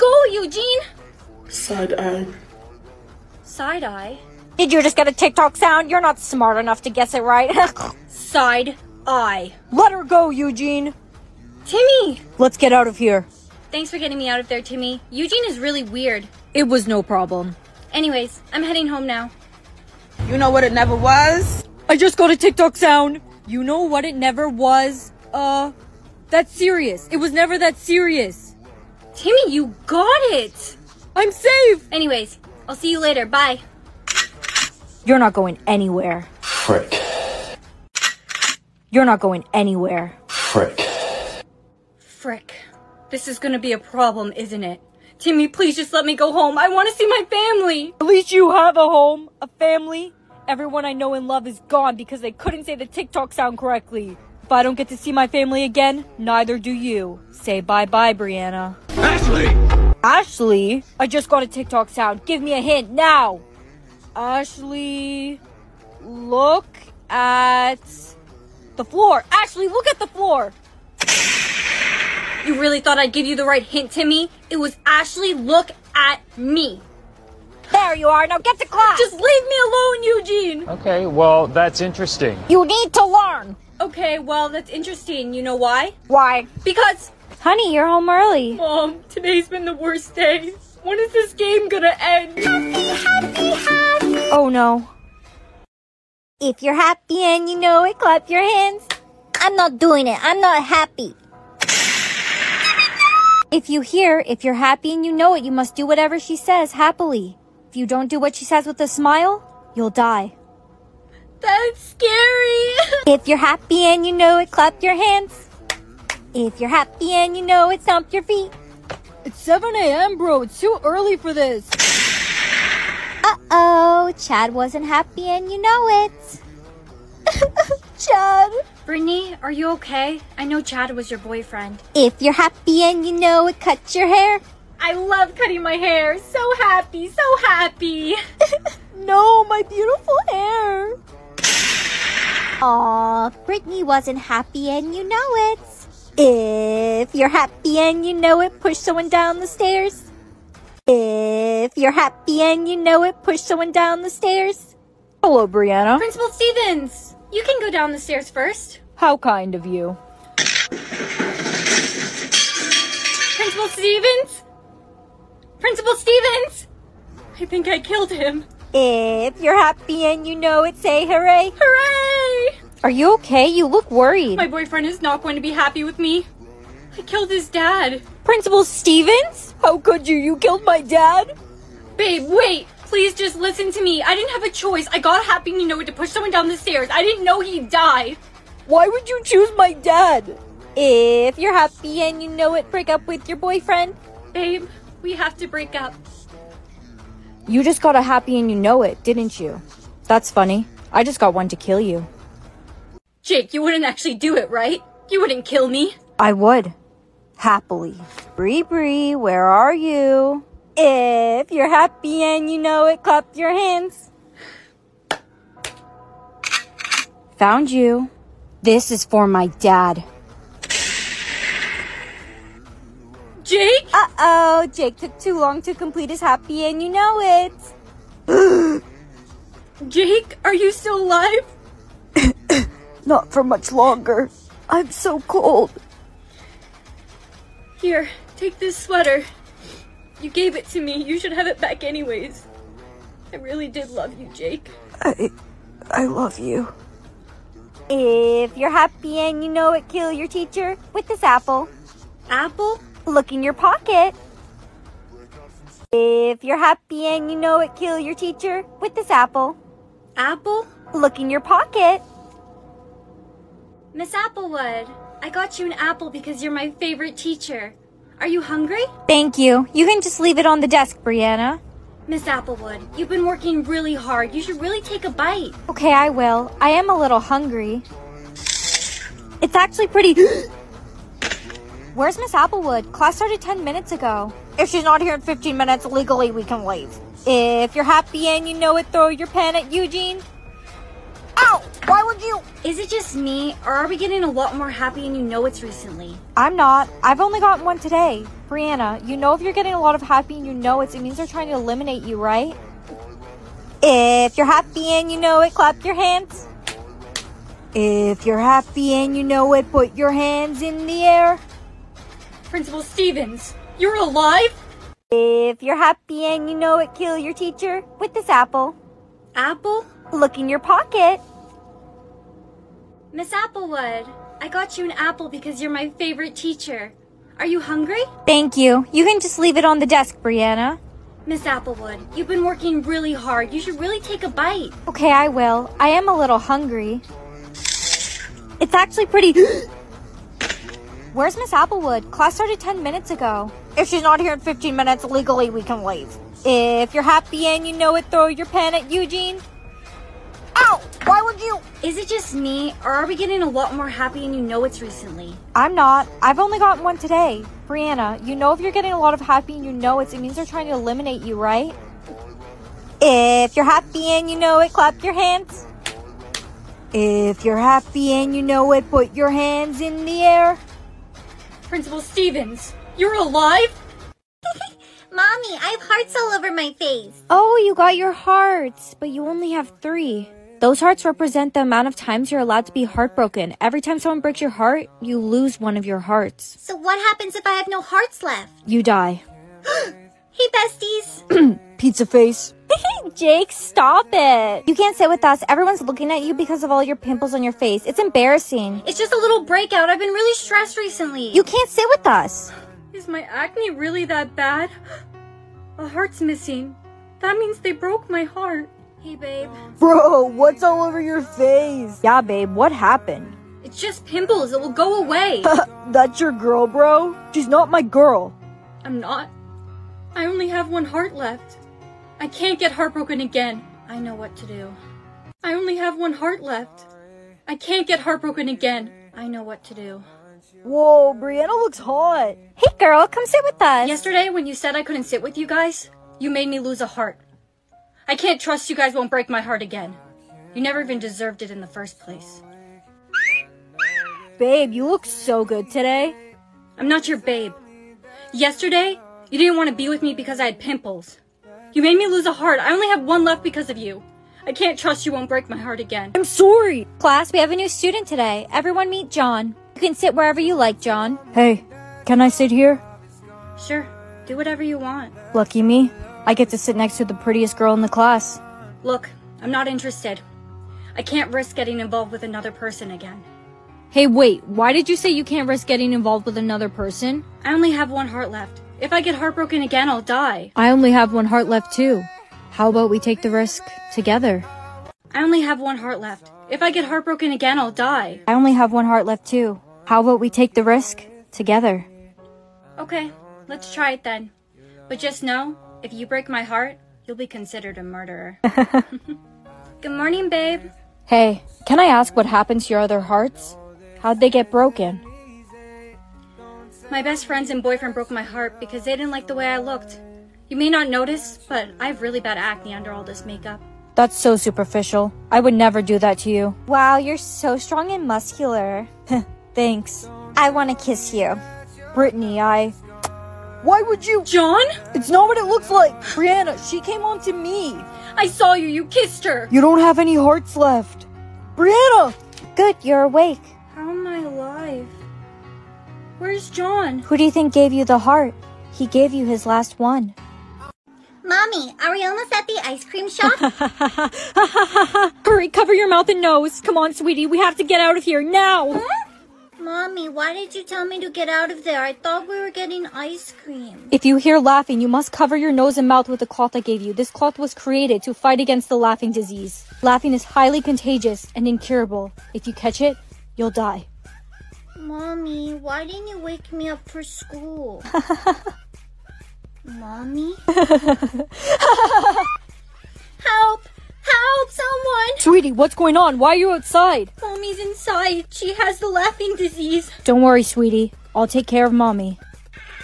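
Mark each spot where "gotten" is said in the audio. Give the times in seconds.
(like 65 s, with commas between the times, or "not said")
297 s, 356 s.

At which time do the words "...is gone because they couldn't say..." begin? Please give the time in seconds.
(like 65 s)
51 s.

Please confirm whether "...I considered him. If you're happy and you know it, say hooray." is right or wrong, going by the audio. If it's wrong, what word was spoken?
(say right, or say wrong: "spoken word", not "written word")
wrong: "killed", not "considered".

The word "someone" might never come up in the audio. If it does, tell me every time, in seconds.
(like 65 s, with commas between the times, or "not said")
148 s, 153 s, 186 s, 383 s, 574 s.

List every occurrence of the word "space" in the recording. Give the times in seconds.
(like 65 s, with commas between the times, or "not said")
not said.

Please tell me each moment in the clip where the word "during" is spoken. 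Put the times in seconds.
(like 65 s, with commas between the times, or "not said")
not said.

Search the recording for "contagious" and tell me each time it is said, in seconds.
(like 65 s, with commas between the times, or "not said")
560 s.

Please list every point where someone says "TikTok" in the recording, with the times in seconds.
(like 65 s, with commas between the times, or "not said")
5 s, 22 s, 52 s, 61 s.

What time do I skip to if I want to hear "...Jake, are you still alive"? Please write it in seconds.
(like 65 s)
229 s.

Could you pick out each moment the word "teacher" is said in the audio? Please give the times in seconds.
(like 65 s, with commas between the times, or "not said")
250 s, 258 s, 267 s, 317 s, 326 s.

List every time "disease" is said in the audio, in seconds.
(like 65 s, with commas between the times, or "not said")
559 s, 579 s.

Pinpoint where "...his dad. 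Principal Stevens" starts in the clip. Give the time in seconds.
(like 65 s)
177 s.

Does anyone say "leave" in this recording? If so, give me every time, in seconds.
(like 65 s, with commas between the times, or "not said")
79 s, 270 s, 286 s, 329 s, 345 s.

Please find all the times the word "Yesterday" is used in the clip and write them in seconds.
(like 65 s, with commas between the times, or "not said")
433 s, 448 s.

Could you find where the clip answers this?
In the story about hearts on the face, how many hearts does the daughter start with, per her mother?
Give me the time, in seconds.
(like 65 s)
378 s.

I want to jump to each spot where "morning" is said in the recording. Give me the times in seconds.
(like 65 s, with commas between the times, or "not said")
499 s.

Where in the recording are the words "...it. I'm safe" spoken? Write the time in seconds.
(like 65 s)
30 s.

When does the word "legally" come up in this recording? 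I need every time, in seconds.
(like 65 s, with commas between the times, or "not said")
285 s, 345 s.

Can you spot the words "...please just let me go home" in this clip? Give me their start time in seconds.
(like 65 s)
45 s.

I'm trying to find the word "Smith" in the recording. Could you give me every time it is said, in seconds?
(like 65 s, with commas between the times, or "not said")
not said.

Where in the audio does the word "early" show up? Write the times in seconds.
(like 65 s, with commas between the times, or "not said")
88 s, 120 s.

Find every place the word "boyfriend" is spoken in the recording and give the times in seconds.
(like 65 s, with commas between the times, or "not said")
131 s, 174 s, 193 s, 507 s.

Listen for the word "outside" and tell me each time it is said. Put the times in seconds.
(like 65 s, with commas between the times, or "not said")
576 s.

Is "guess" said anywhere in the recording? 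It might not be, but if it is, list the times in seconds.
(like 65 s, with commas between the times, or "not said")
6 s.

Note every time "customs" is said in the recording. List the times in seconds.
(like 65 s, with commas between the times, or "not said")
not said.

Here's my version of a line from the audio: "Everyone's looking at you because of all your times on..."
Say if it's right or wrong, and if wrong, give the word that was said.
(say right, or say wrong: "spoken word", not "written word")
wrong: "pimples", not "times".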